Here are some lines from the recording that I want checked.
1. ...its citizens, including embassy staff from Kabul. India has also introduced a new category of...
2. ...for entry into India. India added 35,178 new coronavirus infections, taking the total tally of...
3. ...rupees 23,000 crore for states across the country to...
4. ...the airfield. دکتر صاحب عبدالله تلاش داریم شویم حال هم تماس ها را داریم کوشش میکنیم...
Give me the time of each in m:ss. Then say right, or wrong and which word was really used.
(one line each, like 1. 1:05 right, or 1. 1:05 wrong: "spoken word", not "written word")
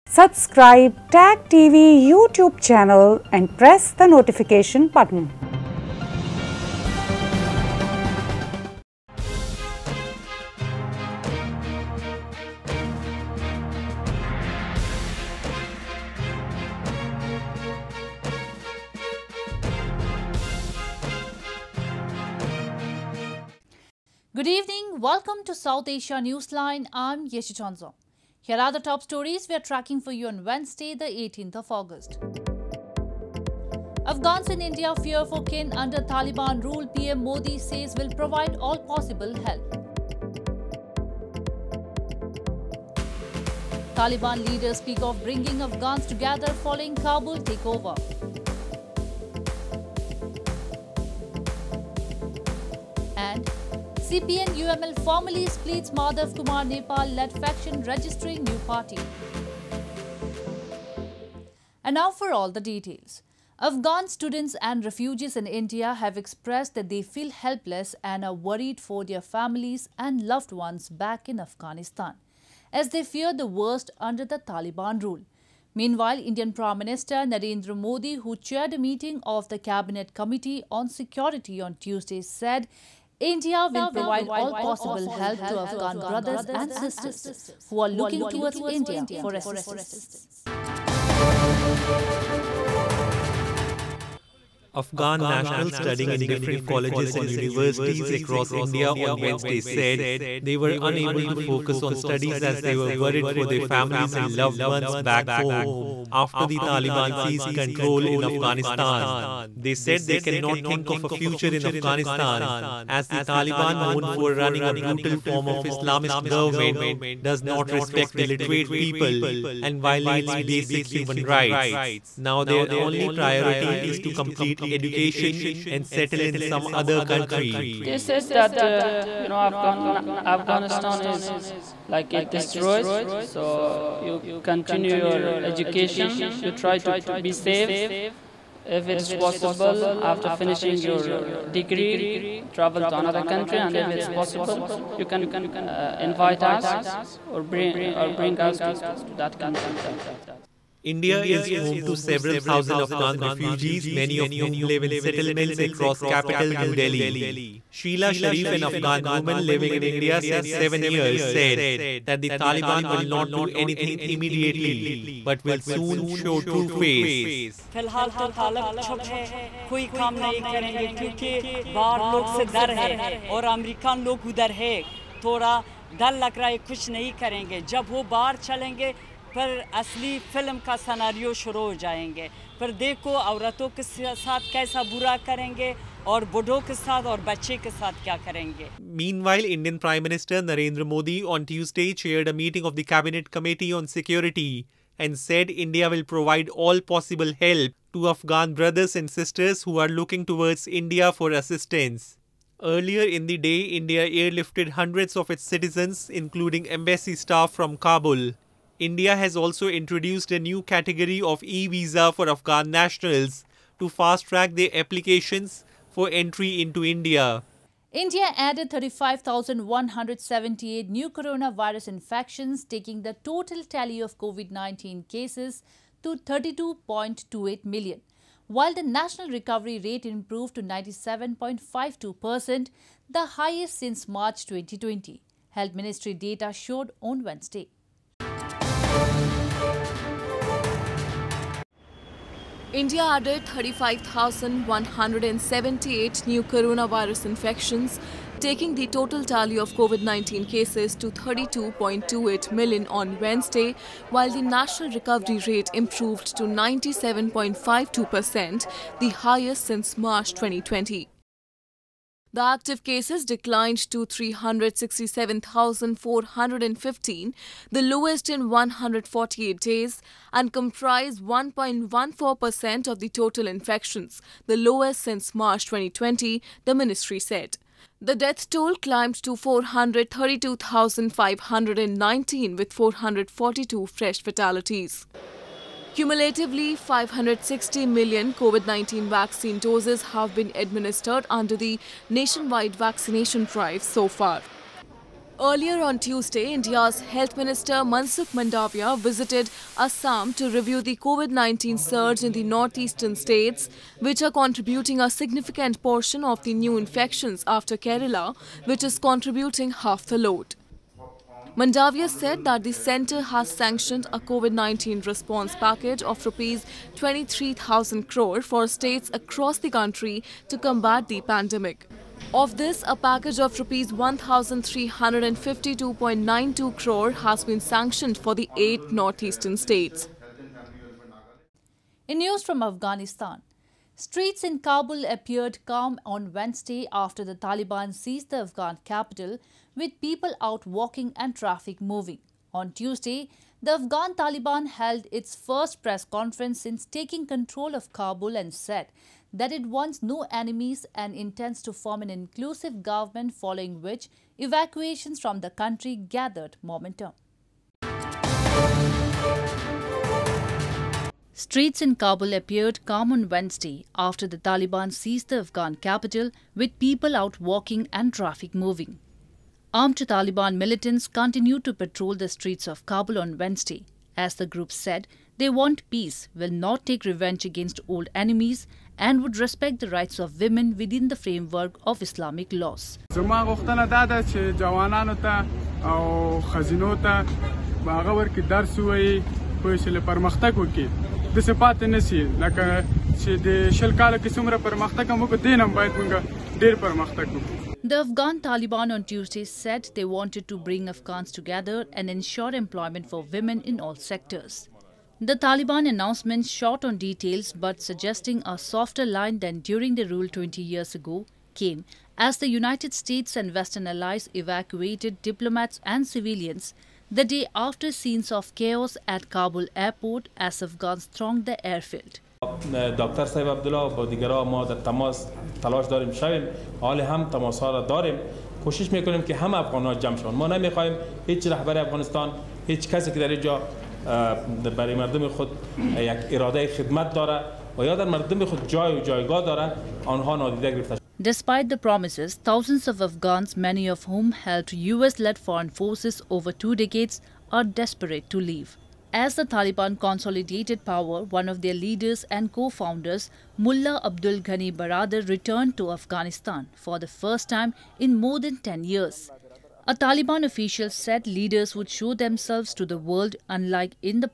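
1. 3:25 right
2. 3:35 right
3. 5:16 right
4. 7:01 right.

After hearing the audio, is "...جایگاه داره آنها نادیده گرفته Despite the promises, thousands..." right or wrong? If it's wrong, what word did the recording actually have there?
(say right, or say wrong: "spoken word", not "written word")
right.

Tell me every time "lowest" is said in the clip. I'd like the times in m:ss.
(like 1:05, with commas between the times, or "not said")
4:27, 4:34.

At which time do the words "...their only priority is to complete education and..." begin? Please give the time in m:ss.
2:02.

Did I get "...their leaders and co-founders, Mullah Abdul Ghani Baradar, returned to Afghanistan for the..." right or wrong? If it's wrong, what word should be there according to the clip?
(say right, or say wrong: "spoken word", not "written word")
right.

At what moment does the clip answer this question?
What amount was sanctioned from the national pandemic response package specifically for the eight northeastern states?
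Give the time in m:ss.
5:23.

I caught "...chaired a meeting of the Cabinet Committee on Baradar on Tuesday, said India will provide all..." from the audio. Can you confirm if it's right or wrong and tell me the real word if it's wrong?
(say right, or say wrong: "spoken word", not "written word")
wrong: "Security", not "Baradar".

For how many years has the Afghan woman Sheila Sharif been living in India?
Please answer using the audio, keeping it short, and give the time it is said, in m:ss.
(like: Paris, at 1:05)
7 years, at 2:40.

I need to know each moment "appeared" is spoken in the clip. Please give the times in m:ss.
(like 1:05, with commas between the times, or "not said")
5:35, 6:02.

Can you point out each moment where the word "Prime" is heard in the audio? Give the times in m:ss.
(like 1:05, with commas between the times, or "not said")
1:16.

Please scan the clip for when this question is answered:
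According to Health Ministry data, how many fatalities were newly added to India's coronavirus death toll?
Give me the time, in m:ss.
4:42.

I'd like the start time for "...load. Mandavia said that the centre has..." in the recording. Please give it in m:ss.
5:10.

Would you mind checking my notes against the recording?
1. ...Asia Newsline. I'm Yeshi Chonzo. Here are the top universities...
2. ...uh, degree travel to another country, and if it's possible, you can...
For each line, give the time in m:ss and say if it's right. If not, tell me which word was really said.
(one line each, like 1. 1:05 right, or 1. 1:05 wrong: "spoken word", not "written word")
1. 0:25 wrong: "stories", not "universities"
2. 2:21 right.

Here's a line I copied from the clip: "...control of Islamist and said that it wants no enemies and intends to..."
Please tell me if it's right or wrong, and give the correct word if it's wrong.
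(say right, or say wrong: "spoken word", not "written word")
wrong: "Kabul", not "Islamist".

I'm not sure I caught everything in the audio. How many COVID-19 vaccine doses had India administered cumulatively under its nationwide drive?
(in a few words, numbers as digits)
560 million.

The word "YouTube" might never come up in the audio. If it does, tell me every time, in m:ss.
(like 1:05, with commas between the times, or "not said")
0:02.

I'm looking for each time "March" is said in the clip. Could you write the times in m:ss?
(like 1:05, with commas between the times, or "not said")
3:54, 4:19, 4:35.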